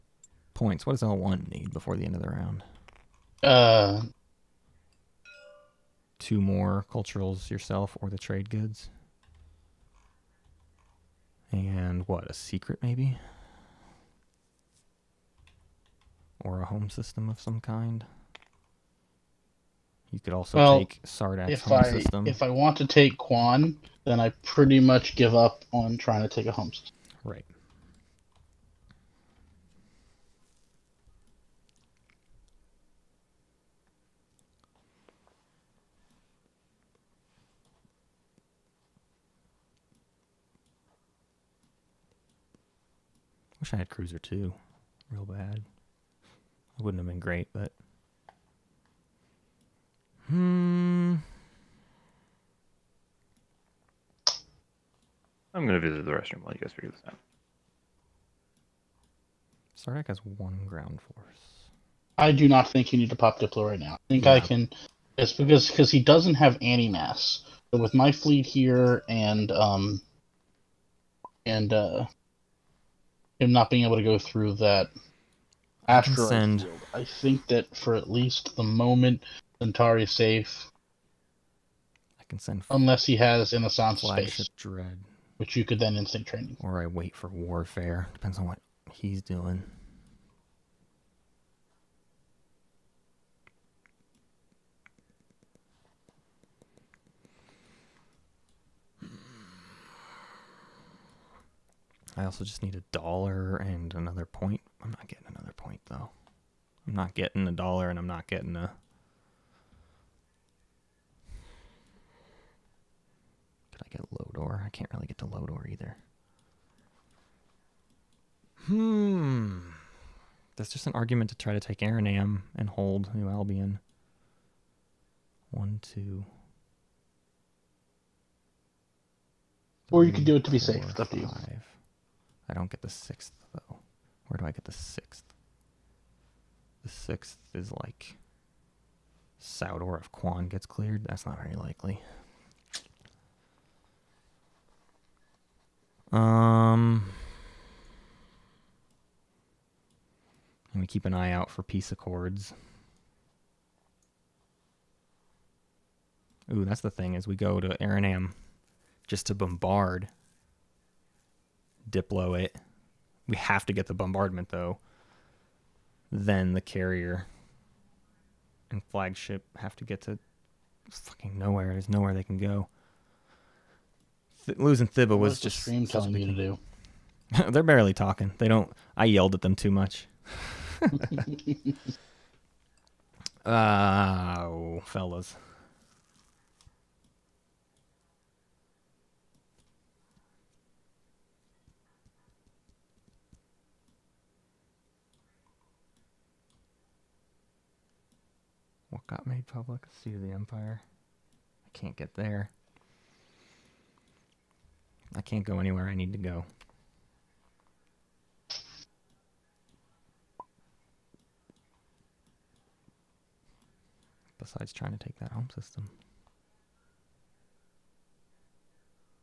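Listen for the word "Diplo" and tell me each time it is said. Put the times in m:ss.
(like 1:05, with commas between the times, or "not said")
1:03, 2:41.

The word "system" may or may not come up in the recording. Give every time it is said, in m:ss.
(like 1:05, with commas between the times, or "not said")
0:16, 0:21, 0:26, 3:35.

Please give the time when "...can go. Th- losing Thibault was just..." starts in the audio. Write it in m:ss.
2:52.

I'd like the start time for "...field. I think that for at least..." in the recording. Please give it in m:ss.
1:16.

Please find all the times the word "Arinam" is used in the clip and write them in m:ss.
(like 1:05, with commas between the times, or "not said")
2:01, 2:37.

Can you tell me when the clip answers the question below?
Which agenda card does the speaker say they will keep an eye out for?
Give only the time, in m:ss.
2:31.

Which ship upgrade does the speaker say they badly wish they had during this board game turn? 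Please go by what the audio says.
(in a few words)
Cruiser 2.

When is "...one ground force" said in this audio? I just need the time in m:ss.
1:00.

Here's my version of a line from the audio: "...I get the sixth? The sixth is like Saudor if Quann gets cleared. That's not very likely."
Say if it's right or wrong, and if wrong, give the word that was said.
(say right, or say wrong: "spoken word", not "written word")
right.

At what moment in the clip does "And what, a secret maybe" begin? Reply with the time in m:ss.
0:11.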